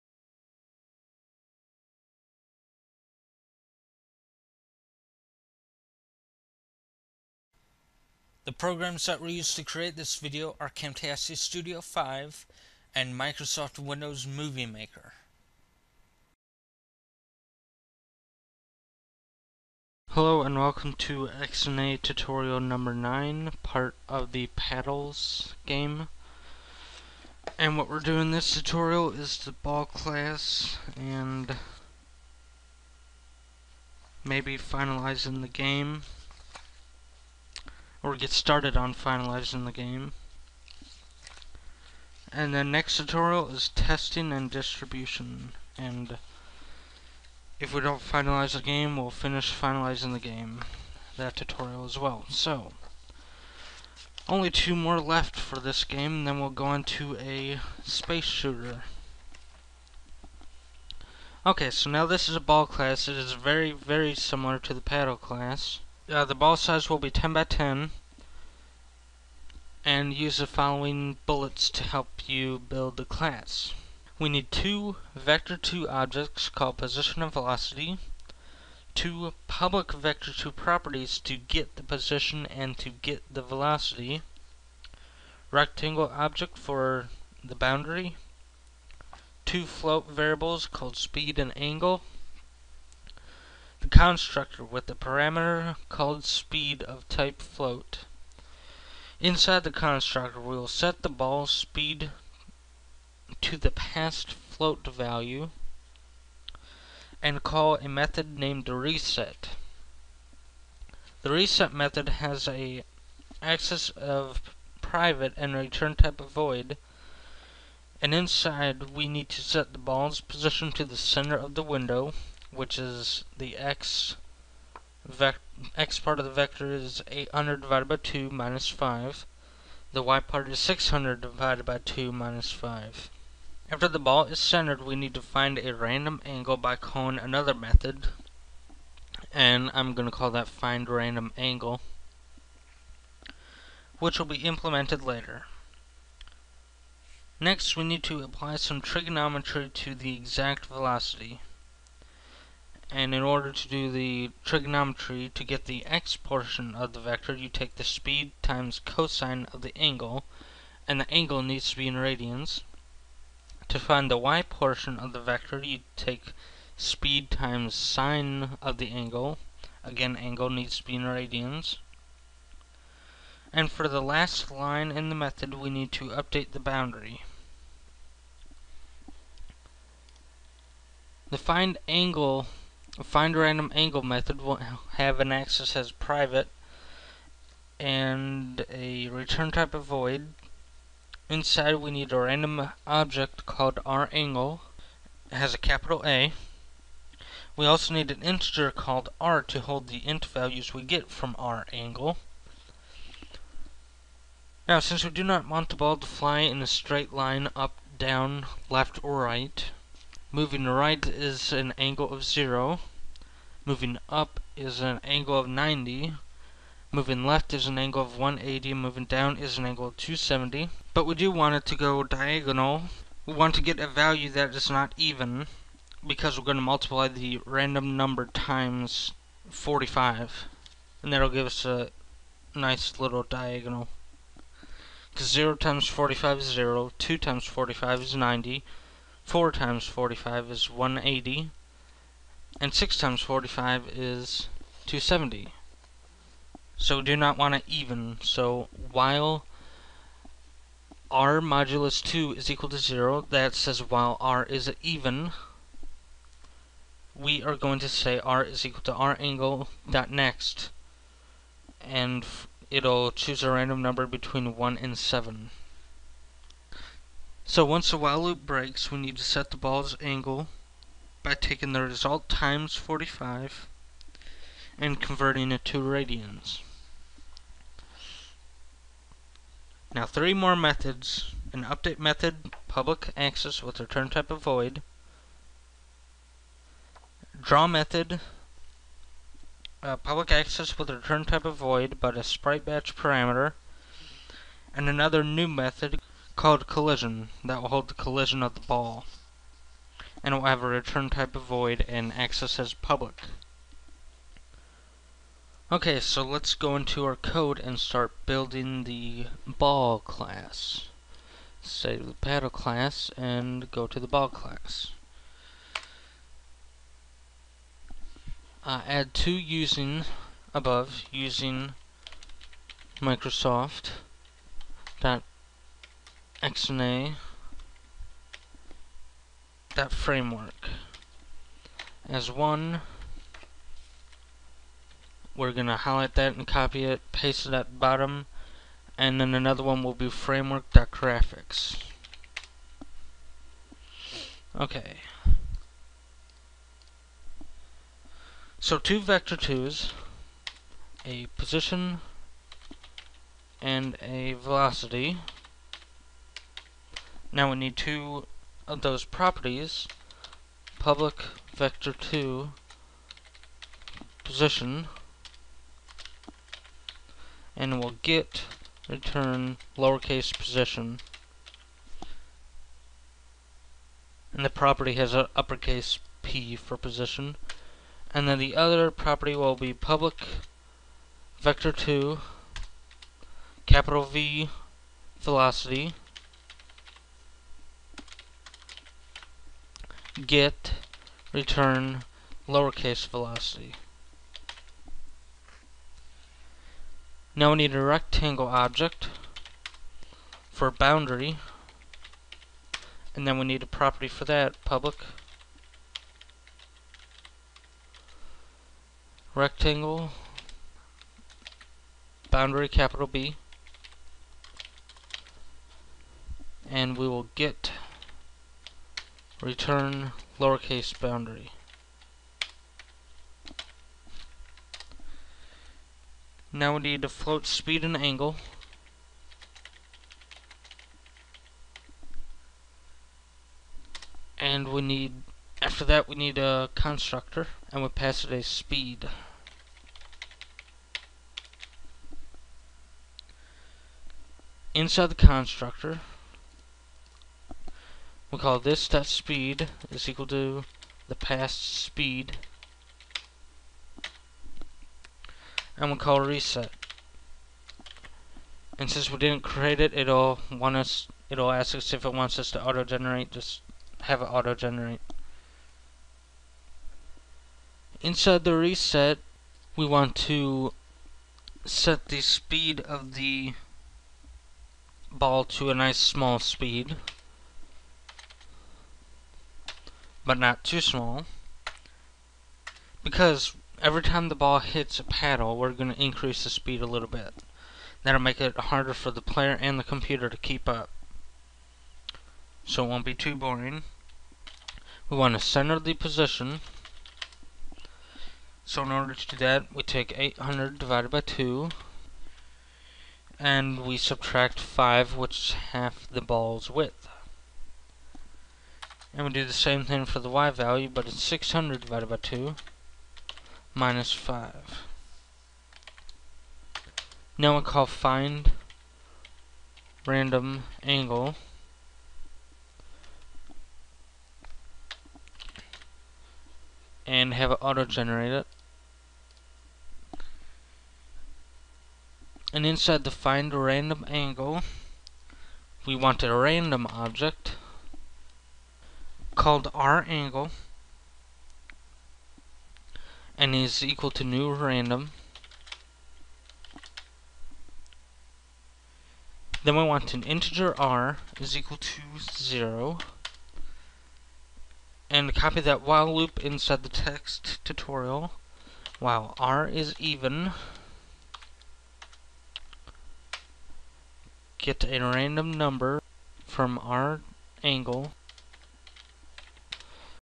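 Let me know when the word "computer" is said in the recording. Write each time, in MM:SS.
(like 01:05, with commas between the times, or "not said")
08:09.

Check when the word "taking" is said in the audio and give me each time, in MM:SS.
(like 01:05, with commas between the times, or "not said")
04:31.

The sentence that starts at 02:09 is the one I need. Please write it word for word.
The y part is 600 divided by 2 minus 5.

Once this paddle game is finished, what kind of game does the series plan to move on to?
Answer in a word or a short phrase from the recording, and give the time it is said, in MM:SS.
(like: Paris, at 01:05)
A space shooter, at 00:57.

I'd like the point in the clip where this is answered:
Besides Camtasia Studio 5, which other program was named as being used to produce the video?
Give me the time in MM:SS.
00:13.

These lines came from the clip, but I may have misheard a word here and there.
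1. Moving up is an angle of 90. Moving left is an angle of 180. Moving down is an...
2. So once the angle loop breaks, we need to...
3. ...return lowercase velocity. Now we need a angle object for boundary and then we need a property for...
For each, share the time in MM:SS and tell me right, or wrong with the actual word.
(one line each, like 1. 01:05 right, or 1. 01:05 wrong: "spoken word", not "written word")
1. 03:33 right
2. 04:27 wrong: "while", not "angle"
3. 06:31 wrong: "rectangle", not "angle".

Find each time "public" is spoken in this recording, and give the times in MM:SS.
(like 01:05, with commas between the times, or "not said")
01:19, 04:42, 04:49, 05:02, 06:00, 06:19, 06:44.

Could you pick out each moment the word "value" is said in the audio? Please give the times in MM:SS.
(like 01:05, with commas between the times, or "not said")
01:44, 03:20, 03:43, 08:30.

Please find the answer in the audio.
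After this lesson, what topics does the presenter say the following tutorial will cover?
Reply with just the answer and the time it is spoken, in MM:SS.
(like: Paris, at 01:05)
Testing and distribution, at 00:43.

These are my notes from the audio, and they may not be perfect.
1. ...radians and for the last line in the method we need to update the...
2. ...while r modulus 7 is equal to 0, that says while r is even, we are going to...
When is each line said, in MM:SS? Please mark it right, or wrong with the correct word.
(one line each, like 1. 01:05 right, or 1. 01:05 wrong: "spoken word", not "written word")
1. 02:51 right
2. 04:08 wrong: "2", not "7".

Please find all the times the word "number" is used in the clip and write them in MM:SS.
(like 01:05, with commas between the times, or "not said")
00:22, 03:47, 04:23, 09:25.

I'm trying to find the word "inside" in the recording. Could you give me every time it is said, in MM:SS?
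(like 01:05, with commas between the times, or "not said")
01:39, 01:58, 03:11, 07:24, 07:47, 08:52, 09:16.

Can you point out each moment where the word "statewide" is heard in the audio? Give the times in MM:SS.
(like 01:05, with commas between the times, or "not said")
not said.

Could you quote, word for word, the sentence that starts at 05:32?
As one, we're going to highlight that and copy it, paste it at the bottom, and then another one will be framework.graphics.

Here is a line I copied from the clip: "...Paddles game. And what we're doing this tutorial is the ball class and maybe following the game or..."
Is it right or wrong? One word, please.
wrong.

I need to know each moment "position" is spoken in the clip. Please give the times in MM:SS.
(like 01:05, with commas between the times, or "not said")
01:16, 01:21, 02:00, 05:51, 06:04, 06:10, 06:16, 08:15.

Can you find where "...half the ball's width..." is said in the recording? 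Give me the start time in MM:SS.
08:25.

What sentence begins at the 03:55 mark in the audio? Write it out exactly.
Because 0 times 45 is 0, 2 times 45 is 90, 4 times 45 is 180, and 6 times 45 is 270.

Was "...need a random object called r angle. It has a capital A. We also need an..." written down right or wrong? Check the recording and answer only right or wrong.
right.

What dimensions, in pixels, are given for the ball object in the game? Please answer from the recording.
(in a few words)
10 by 10.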